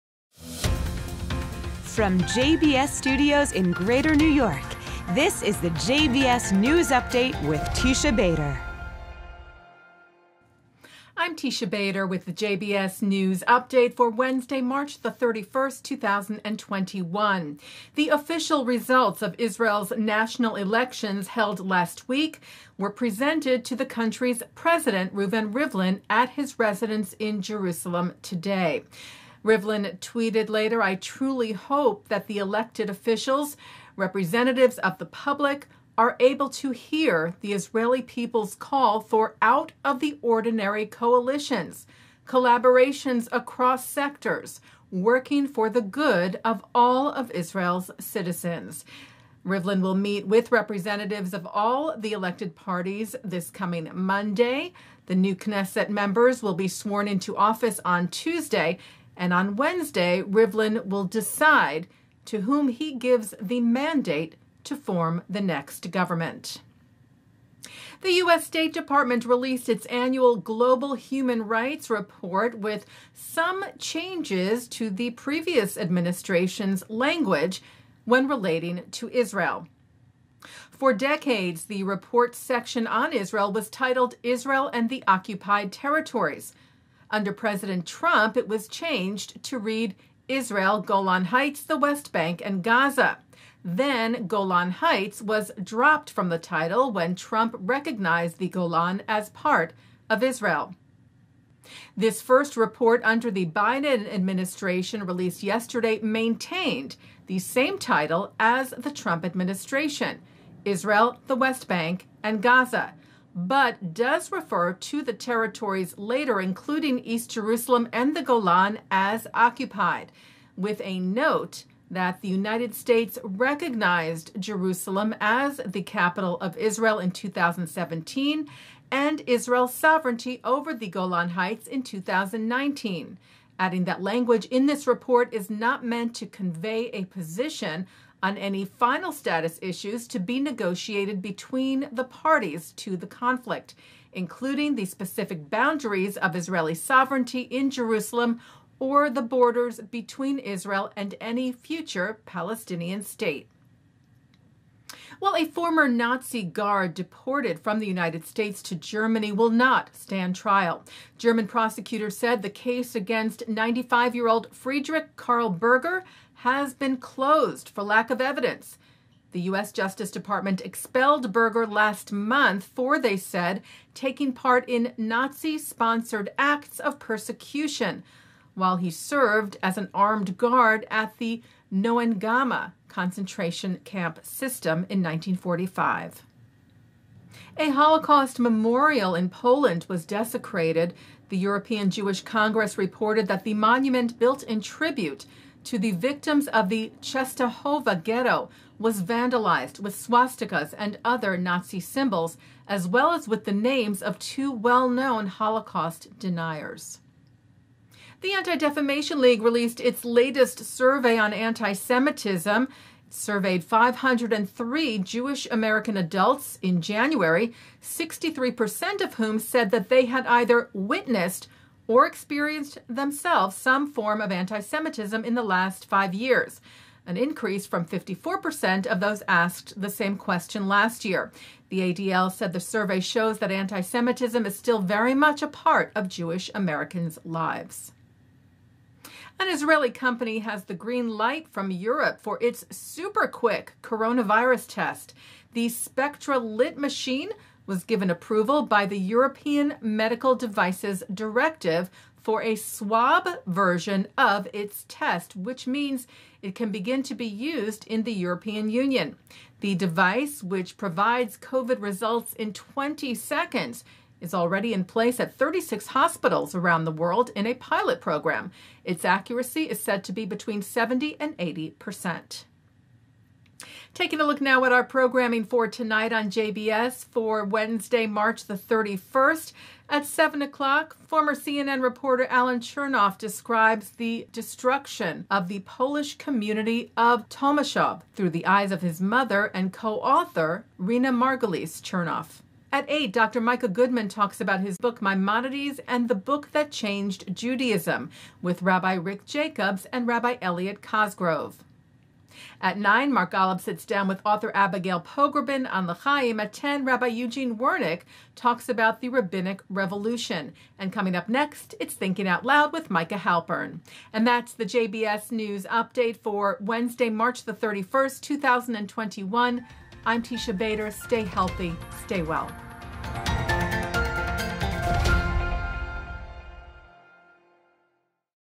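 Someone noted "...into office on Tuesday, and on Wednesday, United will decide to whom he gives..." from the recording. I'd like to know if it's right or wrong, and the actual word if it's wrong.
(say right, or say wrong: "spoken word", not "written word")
wrong: "Rivlin", not "United".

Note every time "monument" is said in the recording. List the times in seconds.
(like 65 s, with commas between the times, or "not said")
193 s.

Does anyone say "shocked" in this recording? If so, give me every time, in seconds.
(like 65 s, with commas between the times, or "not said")
not said.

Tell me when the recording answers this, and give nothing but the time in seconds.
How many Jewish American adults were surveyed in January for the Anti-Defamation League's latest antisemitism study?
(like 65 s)
213 s.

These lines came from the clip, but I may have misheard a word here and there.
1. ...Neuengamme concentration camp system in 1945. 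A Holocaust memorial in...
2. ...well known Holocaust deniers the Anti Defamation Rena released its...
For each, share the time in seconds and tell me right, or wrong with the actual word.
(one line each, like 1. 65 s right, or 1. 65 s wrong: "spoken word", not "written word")
1. 181 s right
2. 204 s wrong: "League", not "Rena".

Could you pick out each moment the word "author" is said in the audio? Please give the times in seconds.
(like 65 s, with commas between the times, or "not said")
289 s, 304 s.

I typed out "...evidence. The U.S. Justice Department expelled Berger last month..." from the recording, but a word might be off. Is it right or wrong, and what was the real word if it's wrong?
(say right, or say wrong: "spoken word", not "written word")
right.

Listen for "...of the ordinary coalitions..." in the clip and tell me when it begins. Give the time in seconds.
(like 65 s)
39 s.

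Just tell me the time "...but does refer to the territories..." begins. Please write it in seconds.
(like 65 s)
113 s.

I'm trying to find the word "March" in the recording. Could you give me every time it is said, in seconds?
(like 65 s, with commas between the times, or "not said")
14 s, 278 s, 317 s.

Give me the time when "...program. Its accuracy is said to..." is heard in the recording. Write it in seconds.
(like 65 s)
267 s.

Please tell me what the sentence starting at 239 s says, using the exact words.
An Israeli company has the green light from Europe for its super quick coronavirus test.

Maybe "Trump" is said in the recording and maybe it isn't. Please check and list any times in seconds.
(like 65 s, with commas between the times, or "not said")
87 s, 97 s, 108 s.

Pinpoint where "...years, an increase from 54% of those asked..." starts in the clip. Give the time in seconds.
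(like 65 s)
226 s.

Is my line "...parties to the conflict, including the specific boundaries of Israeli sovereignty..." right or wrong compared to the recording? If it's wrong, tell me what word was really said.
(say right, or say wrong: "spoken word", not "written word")
right.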